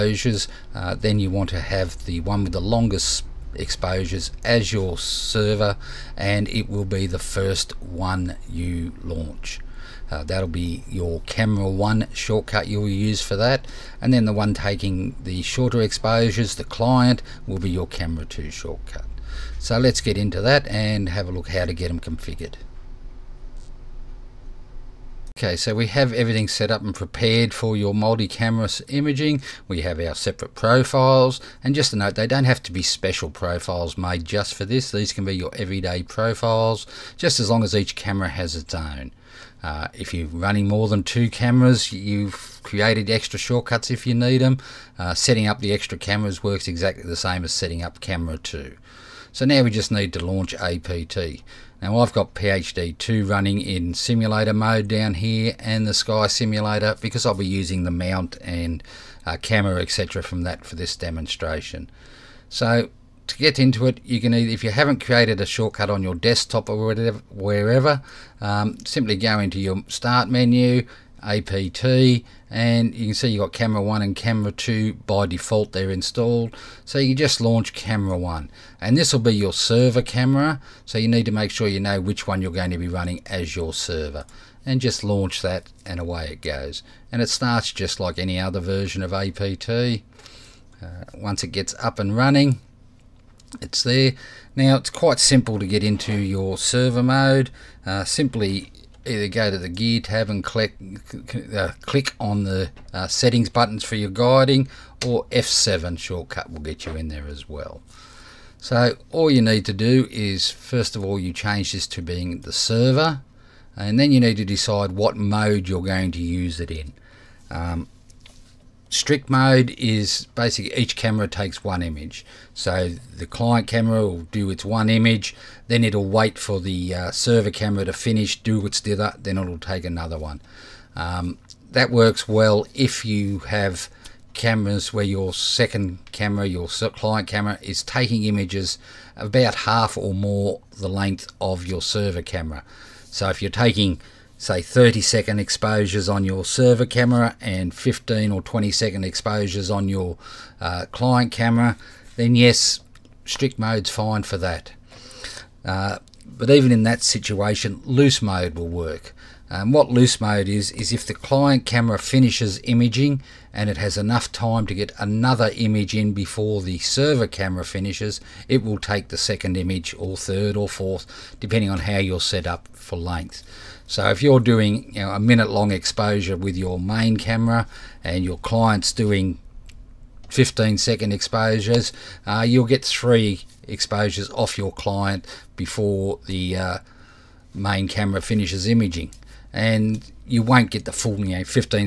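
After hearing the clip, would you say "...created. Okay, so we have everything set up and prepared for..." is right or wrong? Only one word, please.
wrong.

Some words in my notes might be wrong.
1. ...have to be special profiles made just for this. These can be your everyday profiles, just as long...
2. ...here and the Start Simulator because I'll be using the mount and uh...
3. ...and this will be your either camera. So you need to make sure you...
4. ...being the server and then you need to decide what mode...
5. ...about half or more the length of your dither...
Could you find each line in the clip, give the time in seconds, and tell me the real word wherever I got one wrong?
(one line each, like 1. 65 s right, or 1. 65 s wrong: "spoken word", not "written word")
1. 32 s right
2. 55 s wrong: "Sky", not "Start"
3. 78 s wrong: "server", not "either"
4. 112 s right
5. 139 s wrong: "server", not "dither".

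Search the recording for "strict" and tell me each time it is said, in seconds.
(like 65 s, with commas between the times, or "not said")
118 s, 153 s.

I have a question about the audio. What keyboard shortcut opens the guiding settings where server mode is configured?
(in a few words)
F7.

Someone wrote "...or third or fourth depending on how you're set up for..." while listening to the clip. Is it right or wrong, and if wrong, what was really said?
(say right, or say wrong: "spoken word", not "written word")
right.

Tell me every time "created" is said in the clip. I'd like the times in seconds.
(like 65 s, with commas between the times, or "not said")
42 s, 65 s.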